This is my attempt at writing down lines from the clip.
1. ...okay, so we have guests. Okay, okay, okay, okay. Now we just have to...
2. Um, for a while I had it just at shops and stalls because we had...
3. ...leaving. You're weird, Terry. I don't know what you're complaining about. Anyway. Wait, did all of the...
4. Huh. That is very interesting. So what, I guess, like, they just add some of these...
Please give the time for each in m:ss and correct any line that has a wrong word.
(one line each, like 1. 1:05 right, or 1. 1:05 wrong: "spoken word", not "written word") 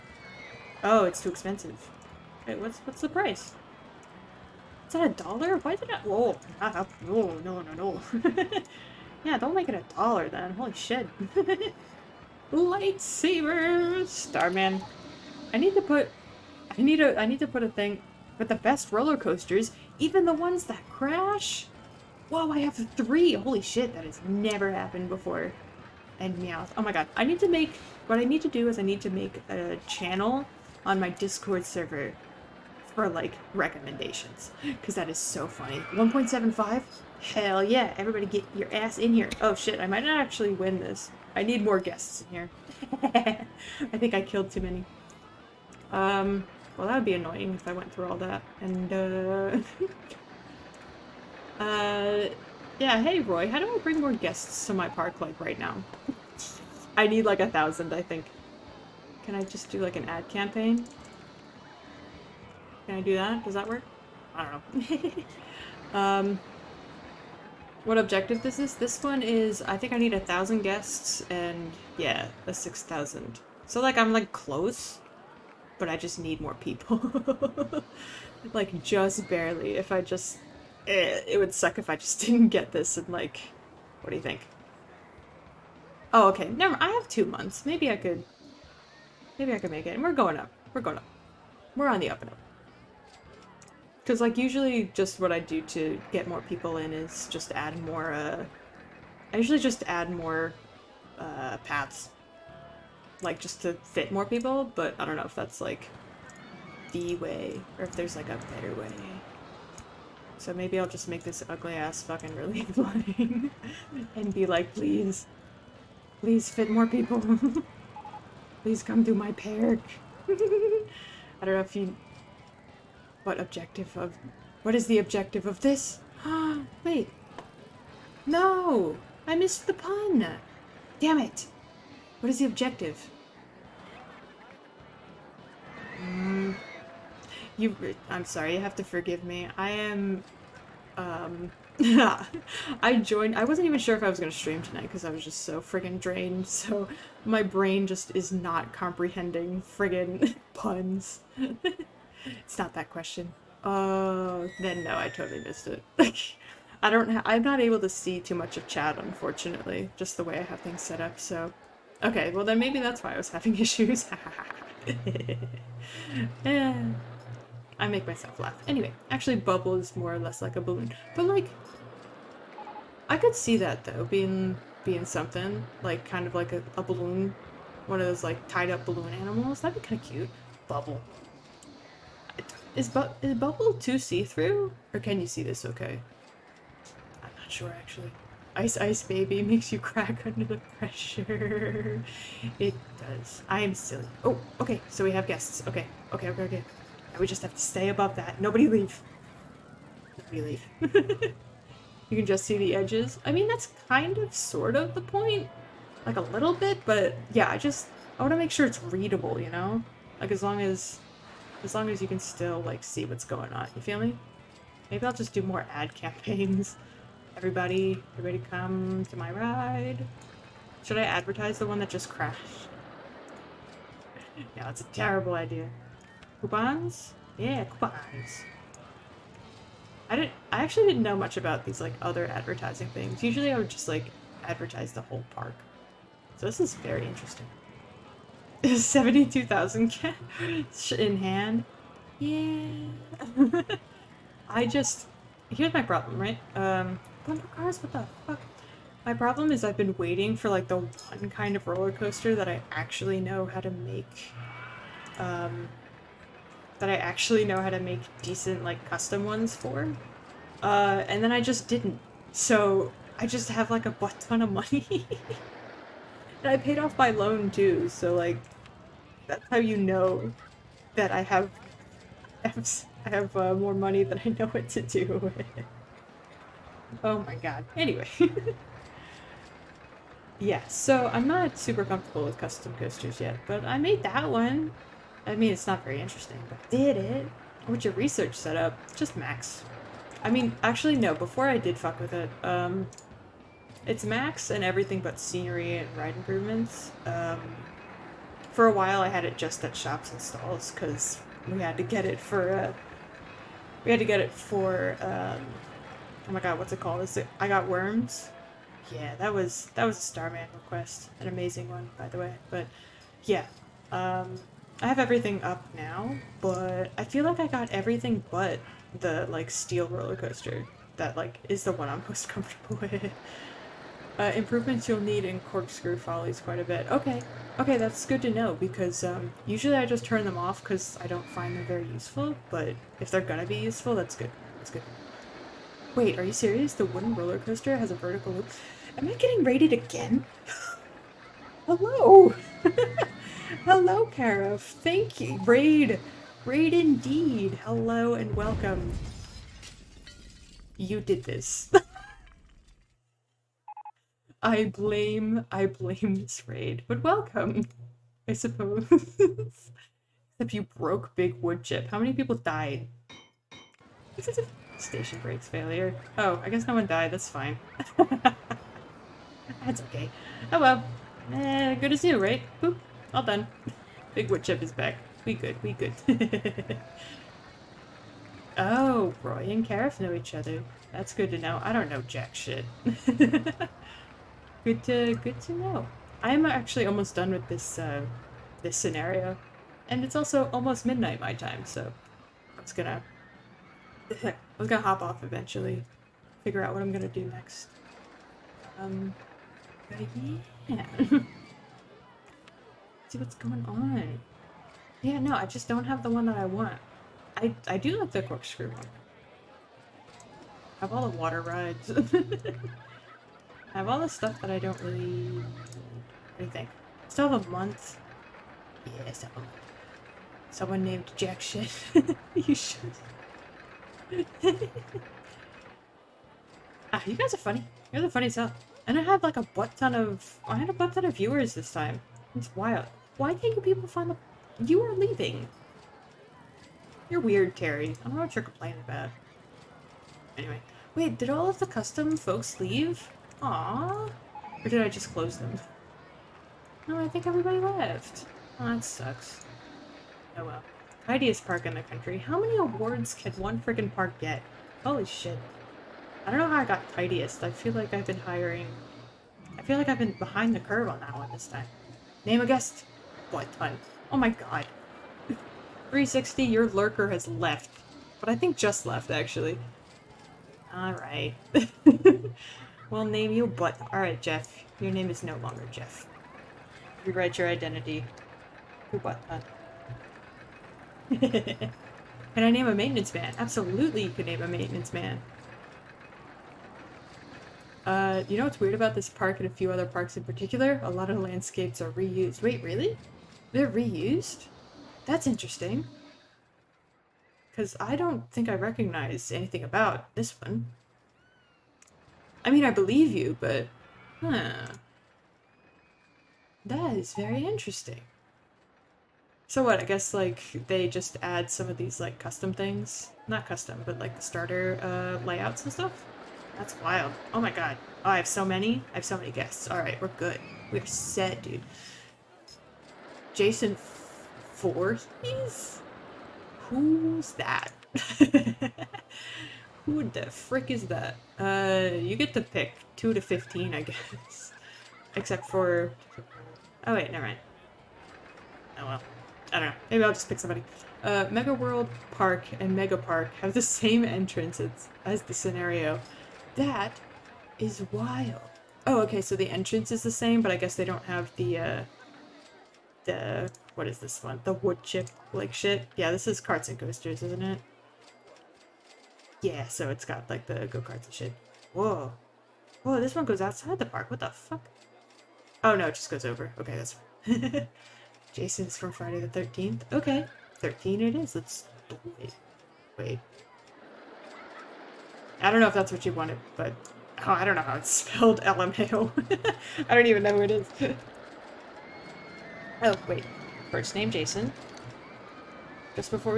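1. 3:14 right
2. 4:57 right
3. 7:14 right
4. 8:24 right.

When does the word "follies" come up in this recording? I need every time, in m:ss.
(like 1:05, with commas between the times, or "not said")
5:25.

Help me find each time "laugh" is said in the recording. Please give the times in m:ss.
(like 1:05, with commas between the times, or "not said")
2:48.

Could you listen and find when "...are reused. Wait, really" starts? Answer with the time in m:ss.
8:11.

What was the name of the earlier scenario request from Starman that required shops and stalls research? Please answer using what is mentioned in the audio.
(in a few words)
I got worms.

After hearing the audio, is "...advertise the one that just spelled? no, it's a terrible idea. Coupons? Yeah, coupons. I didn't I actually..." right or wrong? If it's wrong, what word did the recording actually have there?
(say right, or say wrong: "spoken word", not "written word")
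wrong: "crashed", not "spelled".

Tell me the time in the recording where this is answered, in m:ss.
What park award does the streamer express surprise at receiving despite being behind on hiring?
7:31.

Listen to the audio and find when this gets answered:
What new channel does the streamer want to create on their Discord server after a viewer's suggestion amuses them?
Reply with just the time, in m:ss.
0:33.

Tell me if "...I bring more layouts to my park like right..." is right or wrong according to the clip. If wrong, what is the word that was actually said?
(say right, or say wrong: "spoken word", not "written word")
wrong: "guests", not "layouts".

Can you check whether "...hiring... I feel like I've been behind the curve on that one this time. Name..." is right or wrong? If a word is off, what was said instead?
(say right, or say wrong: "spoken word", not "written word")
right.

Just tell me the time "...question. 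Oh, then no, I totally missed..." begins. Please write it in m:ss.
2:32.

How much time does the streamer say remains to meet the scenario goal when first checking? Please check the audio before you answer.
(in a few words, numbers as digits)
two months.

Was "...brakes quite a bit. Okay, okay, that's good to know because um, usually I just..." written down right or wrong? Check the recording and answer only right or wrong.
wrong.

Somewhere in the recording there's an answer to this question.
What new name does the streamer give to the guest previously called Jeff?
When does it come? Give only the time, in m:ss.
7:58.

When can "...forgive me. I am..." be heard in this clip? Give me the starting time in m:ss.
2:18.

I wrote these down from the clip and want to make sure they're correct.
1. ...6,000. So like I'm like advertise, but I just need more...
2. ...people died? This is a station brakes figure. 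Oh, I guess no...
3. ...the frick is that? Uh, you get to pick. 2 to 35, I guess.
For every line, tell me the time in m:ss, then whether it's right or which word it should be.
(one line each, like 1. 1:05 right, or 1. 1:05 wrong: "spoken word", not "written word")
1. 1:12 wrong: "close", not "advertise"
2. 6:02 wrong: "failure", not "figure"
3. 8:50 wrong: "15", not "35".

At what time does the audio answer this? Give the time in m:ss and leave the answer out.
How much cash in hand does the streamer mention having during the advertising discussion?
3:58.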